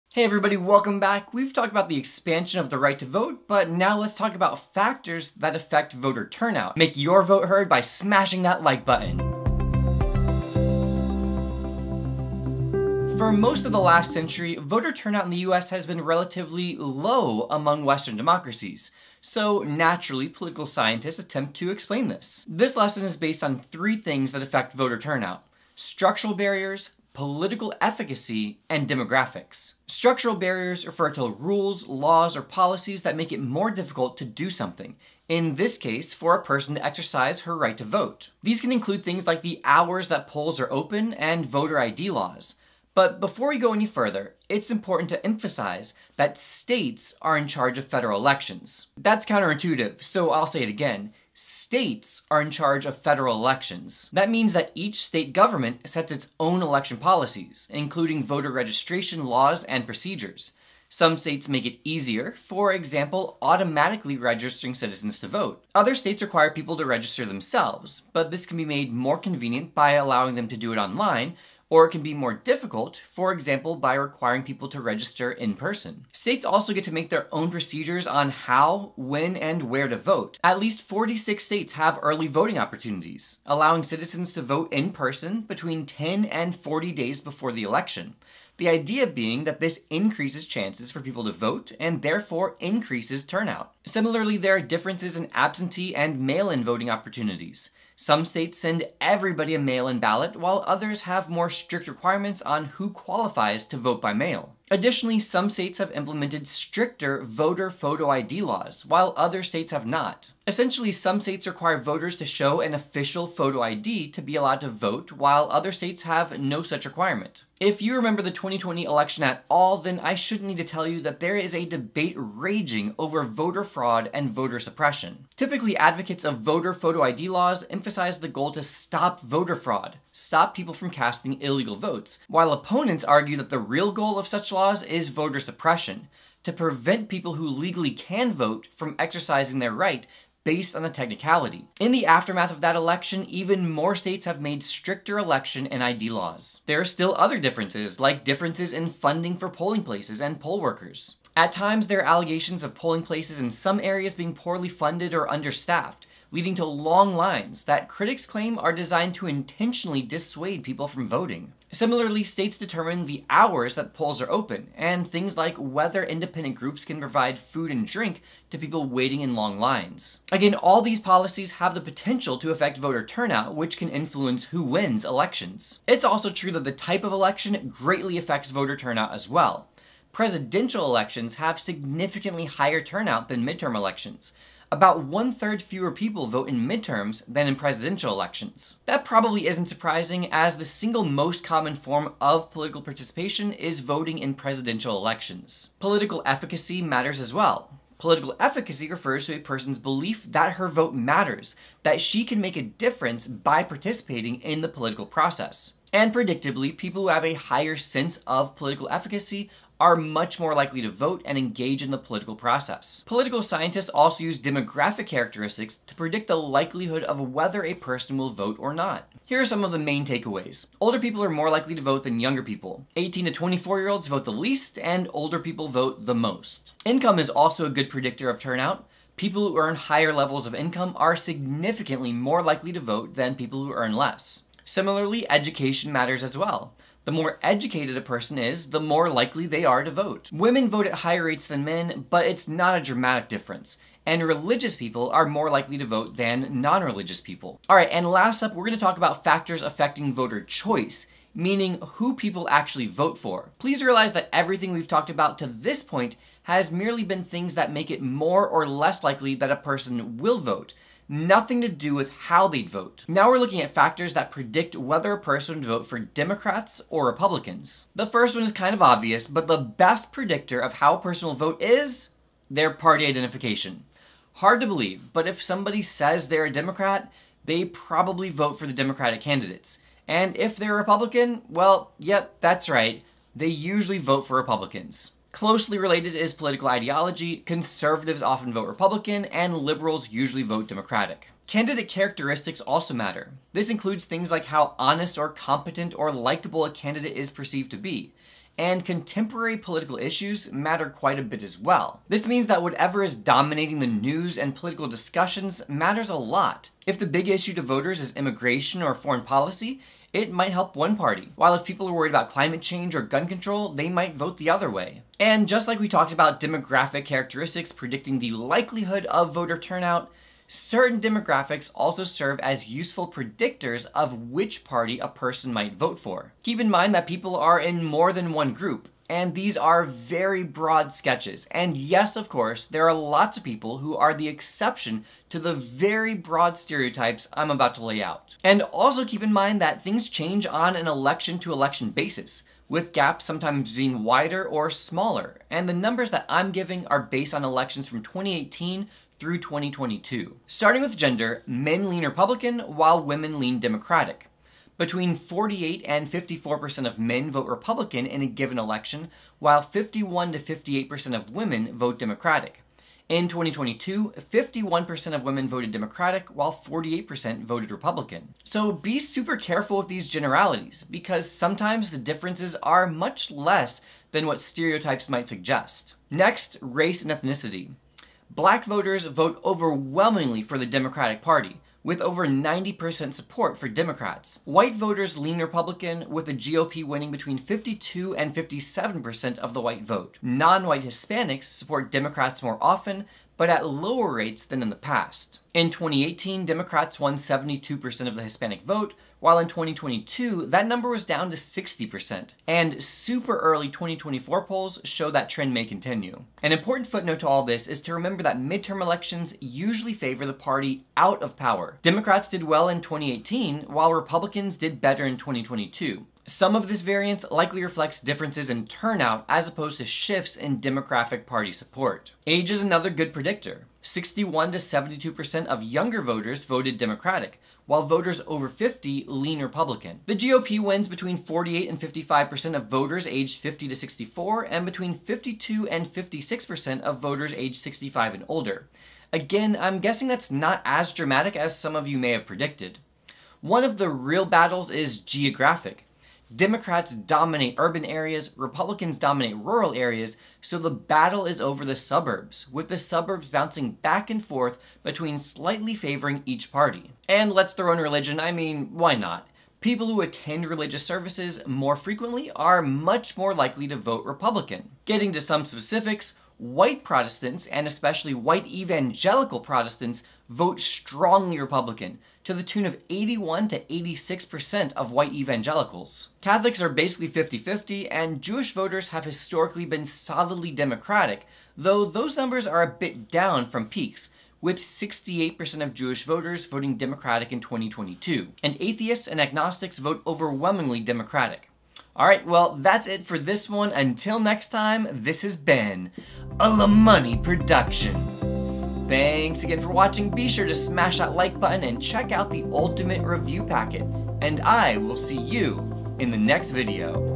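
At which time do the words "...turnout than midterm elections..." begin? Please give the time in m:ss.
3:02.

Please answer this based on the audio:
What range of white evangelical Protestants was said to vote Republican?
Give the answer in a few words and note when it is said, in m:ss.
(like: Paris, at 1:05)
81 to 86%, at 7:52.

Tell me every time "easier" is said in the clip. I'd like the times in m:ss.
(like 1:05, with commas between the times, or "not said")
1:01.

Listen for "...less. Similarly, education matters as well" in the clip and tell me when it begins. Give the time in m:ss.
3:53.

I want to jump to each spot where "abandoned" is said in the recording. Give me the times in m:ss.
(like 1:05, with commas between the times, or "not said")
not said.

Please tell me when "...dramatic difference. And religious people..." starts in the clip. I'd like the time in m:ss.
4:02.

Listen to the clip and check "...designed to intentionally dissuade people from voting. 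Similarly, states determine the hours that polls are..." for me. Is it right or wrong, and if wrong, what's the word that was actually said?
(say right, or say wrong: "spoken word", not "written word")
right.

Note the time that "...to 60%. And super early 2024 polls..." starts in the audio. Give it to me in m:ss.
6:41.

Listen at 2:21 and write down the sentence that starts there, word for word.
In the aftermath of that election, even more states have made stricter election and ID laws.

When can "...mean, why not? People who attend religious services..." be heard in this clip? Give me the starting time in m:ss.
7:38.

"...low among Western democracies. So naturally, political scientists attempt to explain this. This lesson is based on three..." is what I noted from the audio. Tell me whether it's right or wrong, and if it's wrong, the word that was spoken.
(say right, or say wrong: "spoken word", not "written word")
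right.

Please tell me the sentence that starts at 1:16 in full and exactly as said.
States also get to make their own procedures on how, when, and where to vote.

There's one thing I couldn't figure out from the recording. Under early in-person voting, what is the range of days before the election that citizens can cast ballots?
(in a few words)
10 and 40 days.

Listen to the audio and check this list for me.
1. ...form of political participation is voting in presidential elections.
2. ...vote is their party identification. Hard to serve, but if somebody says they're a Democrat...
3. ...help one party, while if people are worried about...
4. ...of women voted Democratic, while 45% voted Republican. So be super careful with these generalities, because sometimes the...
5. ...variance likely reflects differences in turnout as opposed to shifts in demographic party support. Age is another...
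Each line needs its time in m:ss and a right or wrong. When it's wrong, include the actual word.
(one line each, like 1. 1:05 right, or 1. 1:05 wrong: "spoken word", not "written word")
1. 3:11 right
2. 4:31 wrong: "believe", not "serve"
3. 5:10 right
4. 6:05 wrong: "48", not "45"
5. 6:56 right.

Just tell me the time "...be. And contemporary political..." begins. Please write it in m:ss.
4:57.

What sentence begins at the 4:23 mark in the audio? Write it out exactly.
Now we're looking at factors that predict whether a person would vote for Democrats or Republicans.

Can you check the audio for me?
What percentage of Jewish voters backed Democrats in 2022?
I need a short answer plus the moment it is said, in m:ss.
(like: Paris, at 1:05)
68%, at 8:04.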